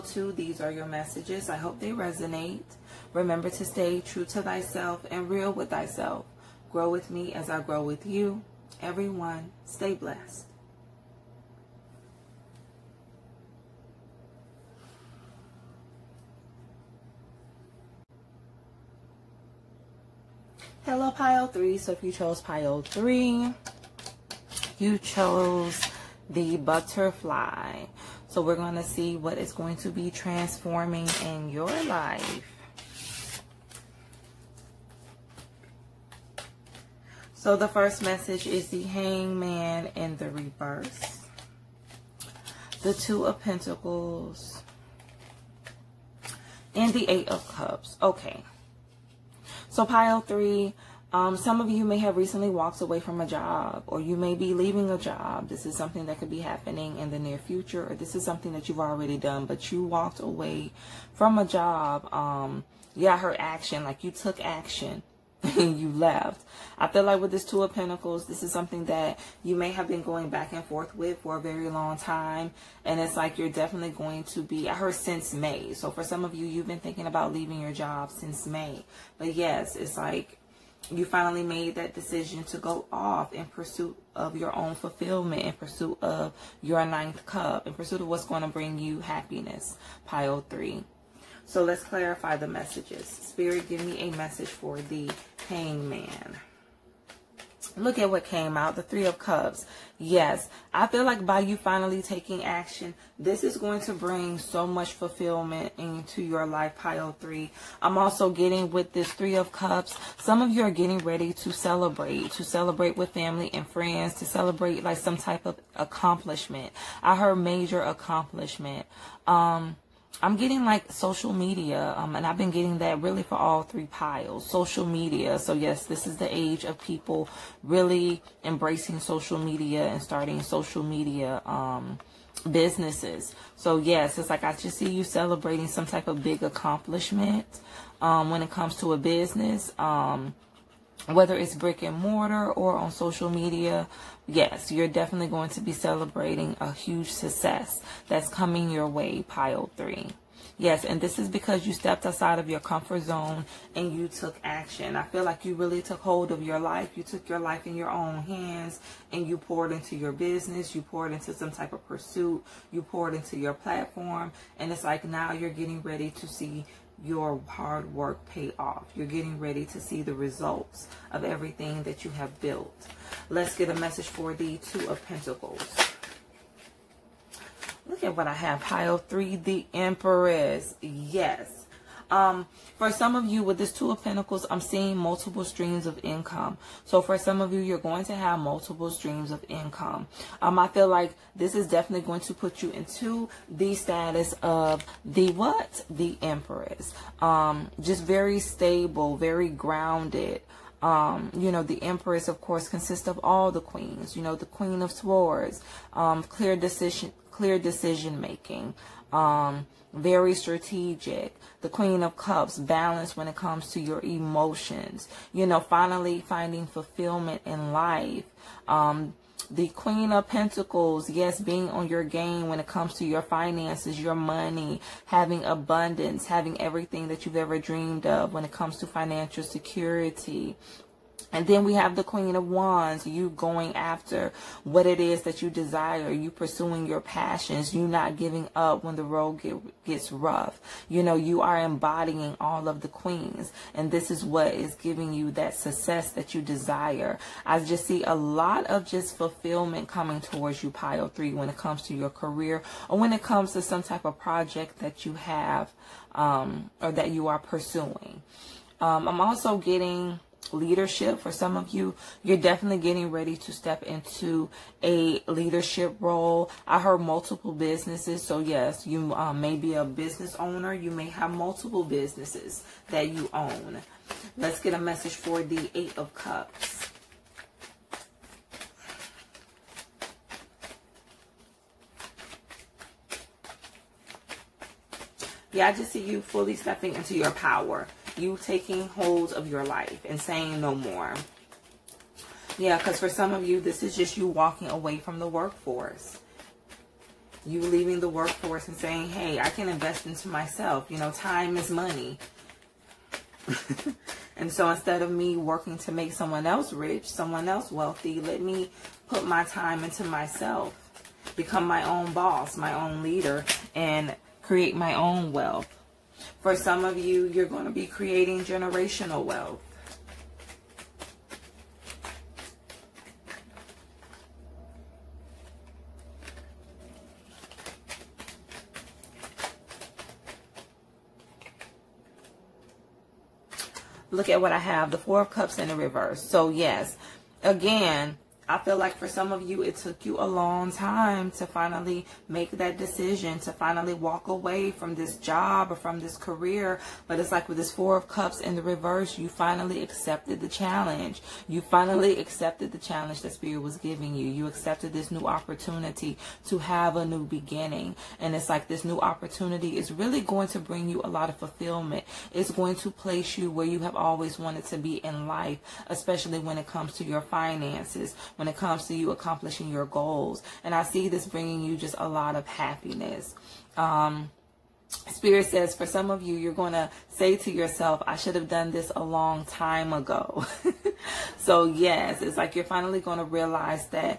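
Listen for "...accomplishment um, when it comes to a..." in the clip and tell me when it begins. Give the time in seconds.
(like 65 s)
136 s.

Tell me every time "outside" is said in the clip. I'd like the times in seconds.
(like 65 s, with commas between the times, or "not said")
152 s.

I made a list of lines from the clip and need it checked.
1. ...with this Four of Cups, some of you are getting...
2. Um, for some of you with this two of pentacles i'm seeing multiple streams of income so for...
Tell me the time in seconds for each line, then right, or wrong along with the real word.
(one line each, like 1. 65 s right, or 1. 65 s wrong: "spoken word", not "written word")
1. 108 s wrong: "Three", not "Four"
2. 182 s right.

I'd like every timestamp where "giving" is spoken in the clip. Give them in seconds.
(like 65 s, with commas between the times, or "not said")
238 s, 244 s, 353 s.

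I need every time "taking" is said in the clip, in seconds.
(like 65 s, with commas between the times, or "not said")
102 s, 288 s.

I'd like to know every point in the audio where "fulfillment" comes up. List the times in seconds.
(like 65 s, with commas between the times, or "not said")
84 s, 104 s, 216 s, 249 s, 361 s.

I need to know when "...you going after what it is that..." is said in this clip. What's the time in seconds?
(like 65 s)
233 s.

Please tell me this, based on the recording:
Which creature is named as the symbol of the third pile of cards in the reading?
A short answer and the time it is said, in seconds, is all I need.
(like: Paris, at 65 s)
The butterfly, at 26 s.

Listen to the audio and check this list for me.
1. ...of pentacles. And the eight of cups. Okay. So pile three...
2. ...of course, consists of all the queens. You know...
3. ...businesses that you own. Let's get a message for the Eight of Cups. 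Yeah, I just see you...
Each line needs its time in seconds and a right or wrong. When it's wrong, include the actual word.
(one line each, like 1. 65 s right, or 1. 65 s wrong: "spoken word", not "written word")
1. 43 s right
2. 202 s right
3. 271 s right.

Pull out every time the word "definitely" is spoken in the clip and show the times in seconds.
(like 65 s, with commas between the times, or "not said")
73 s, 144 s, 191 s, 262 s.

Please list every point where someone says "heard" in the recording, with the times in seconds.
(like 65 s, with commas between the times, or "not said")
74 s, 117 s, 266 s.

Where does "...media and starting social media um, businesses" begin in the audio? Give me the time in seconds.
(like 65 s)
129 s.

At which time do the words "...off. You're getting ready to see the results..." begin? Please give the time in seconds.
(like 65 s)
168 s.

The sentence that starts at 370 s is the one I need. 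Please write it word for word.
And I see this bringing you just a lot of happiness.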